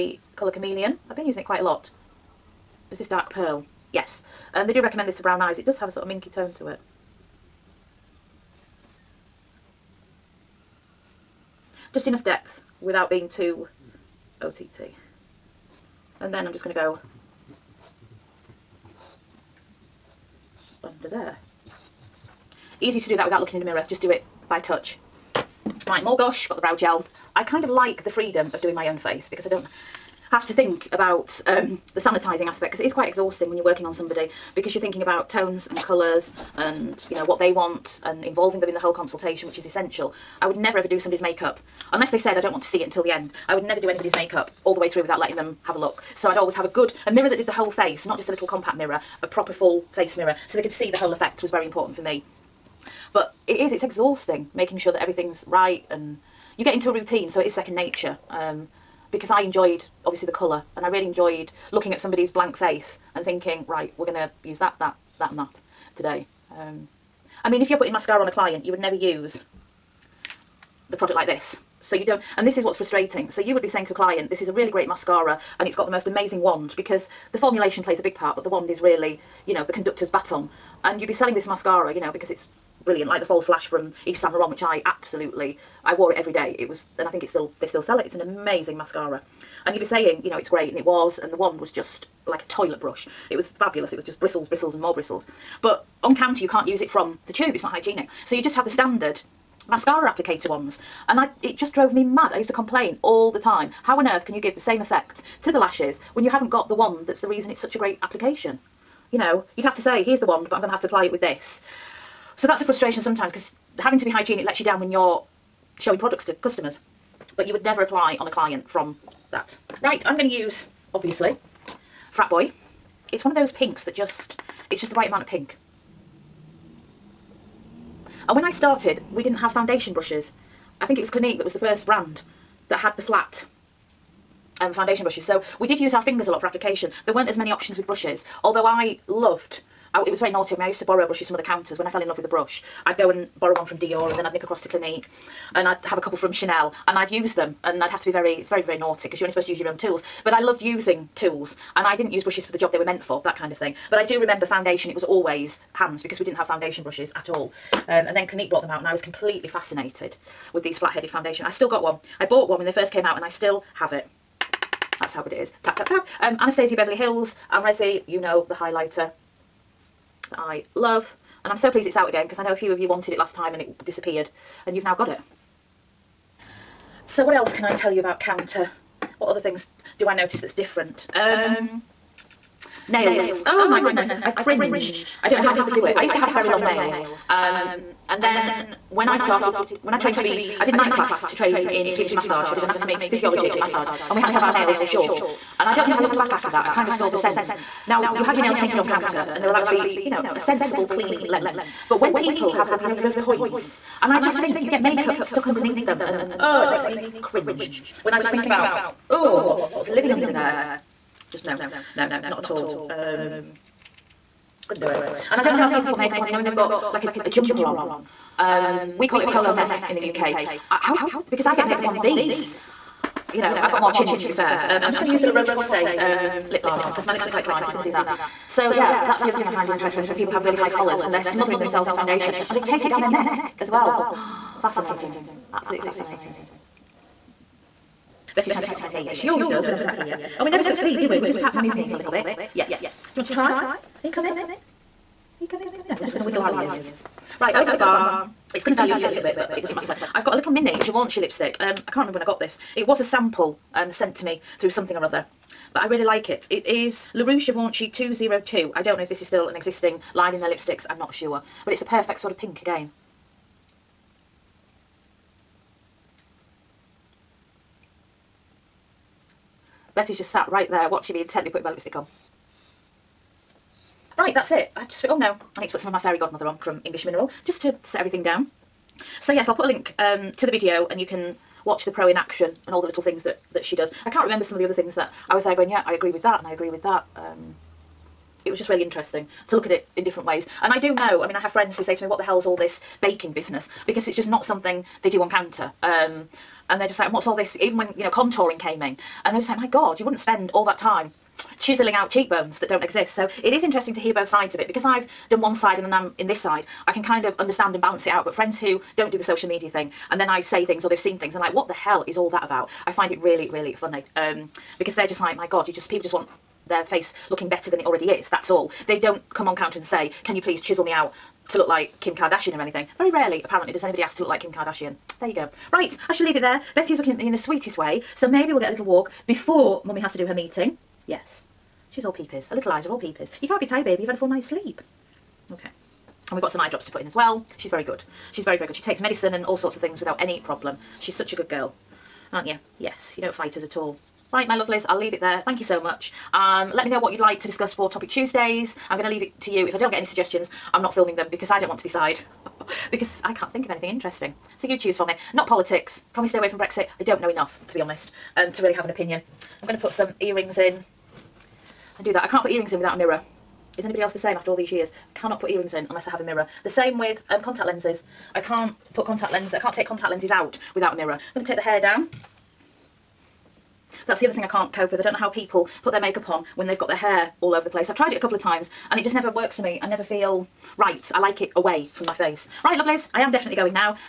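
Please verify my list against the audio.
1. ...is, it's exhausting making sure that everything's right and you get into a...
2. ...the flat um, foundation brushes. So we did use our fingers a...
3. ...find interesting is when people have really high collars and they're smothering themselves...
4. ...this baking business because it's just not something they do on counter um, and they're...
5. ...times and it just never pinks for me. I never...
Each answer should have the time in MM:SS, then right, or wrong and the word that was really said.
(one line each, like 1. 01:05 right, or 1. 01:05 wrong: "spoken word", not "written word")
1. 00:53 right
2. 02:12 right
3. 03:49 right
4. 04:52 right
5. 06:18 wrong: "works", not "pinks".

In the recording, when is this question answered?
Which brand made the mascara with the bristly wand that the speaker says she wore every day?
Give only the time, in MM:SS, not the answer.
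01:24.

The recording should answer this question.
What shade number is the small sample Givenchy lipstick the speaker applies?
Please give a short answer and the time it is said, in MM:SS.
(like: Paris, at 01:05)
202, at 04:17.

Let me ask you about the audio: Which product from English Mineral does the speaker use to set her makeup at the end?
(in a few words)
Fairy Godmother.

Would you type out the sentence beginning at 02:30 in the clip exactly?
But I loved using tools and I didn't use brushes for the job they were meant for, that kind of thing.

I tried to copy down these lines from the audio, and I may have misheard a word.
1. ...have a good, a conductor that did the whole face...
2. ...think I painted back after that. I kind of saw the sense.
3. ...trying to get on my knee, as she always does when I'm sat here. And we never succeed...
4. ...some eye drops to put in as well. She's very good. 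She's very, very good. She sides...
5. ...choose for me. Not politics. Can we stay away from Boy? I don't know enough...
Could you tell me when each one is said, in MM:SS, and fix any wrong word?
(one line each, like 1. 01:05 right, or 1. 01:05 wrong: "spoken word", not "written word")
1. 00:46 wrong: "mirror", not "conductor"
2. 03:15 wrong: "looked", not "painted"
3. 03:58 right
4. 05:36 wrong: "takes", not "sides"
5. 05:54 wrong: "Brexit", not "Boy".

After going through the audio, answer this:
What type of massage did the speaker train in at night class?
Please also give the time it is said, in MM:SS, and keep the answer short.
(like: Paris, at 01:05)
Swedish massage, at 03:11.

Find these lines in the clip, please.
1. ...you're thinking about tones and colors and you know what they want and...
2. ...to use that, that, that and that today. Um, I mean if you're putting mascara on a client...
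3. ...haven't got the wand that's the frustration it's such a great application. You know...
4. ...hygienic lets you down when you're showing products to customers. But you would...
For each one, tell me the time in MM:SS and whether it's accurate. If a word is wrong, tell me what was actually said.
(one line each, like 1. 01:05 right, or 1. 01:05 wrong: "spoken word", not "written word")
1. 00:34 right
2. 01:04 right
3. 01:46 wrong: "reason", not "frustration"
4. 01:54 right.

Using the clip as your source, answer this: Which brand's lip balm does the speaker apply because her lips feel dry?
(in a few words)
La Roche-Posay.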